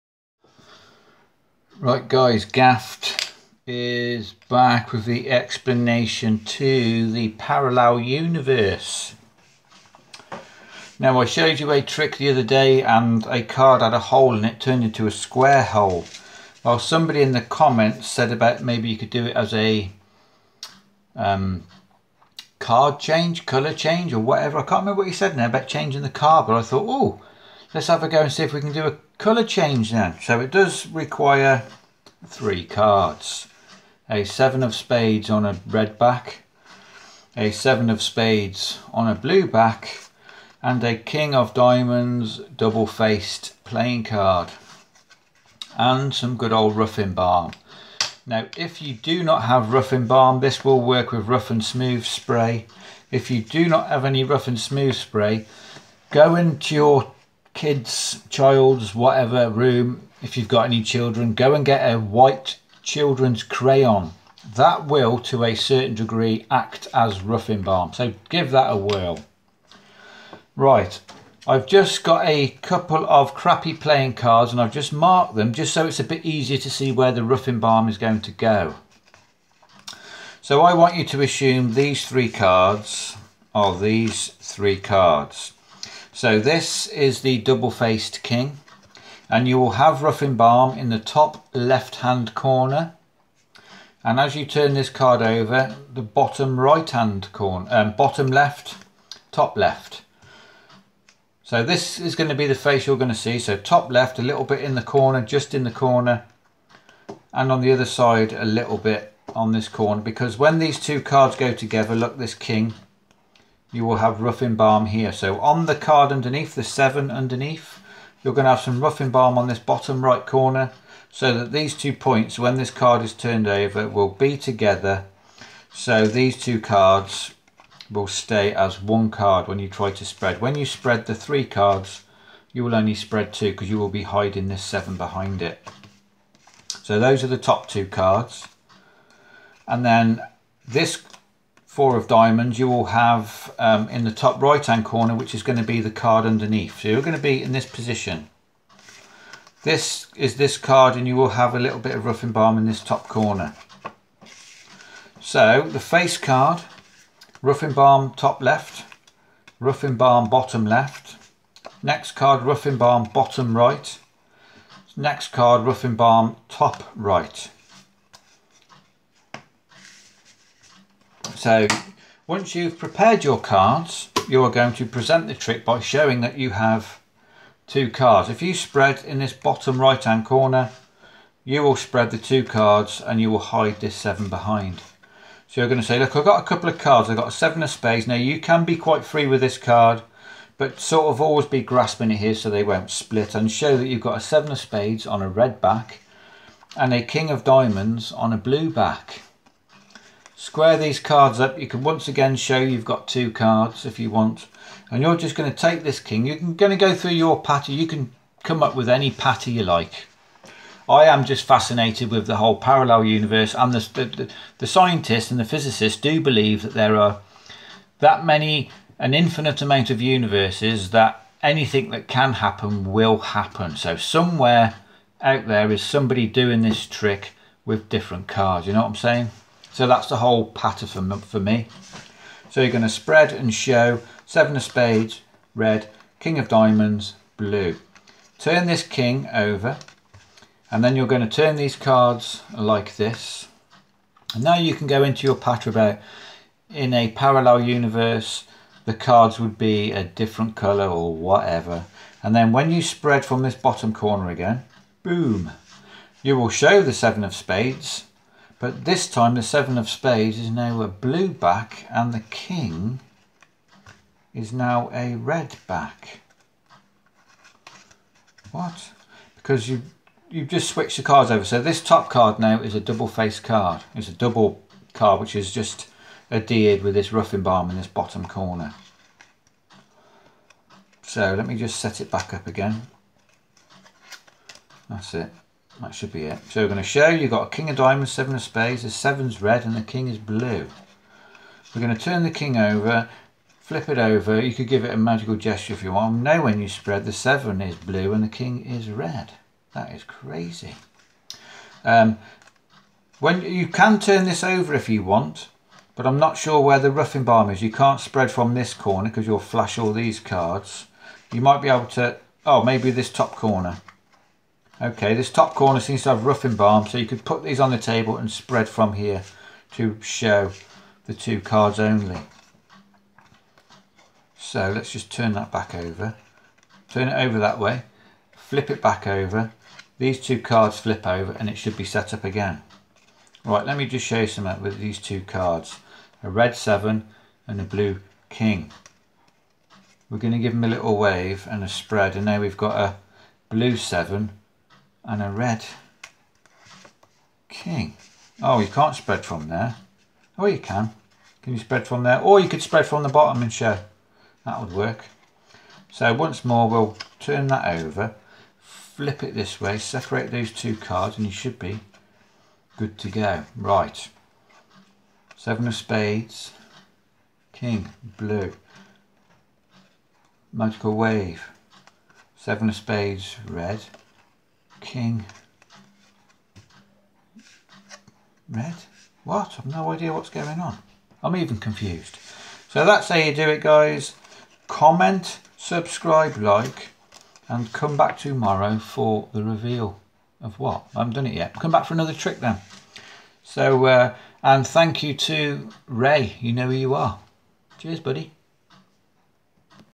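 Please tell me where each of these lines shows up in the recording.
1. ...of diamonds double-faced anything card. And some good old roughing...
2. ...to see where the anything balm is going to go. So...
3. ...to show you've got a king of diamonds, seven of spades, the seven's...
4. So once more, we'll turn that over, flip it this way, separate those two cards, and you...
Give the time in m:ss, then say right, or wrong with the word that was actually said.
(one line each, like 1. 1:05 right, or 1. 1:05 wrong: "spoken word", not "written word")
1. 0:41 wrong: "playing", not "anything"
2. 1:16 wrong: "roughing", not "anything"
3. 4:46 right
4. 5:55 right.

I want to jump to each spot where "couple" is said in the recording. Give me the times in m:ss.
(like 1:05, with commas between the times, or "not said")
1:12, 3:06.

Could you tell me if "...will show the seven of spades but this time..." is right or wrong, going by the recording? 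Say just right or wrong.
right.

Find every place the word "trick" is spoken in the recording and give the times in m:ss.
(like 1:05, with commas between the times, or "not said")
0:11, 2:55, 3:46, 6:32.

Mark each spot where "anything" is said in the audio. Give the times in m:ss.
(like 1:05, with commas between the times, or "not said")
3:41.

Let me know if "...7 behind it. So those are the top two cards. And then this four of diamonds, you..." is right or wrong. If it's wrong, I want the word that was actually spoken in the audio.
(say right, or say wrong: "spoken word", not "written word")
right.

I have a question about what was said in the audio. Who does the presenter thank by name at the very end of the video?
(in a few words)
Ray.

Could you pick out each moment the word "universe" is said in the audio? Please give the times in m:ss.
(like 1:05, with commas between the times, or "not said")
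0:08, 3:33, 3:40, 4:07.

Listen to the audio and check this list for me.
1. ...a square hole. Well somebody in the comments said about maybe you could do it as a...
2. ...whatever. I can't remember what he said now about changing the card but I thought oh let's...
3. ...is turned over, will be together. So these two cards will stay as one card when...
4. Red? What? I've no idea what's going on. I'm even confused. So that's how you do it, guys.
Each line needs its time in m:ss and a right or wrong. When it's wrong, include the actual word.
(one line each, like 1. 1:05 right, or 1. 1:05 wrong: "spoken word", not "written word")
1. 0:15 right
2. 0:24 right
3. 2:03 right
4. 6:18 right.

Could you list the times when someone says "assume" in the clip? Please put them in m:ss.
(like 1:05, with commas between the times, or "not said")
1:21.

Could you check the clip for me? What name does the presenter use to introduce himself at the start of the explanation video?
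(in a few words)
Gaffed.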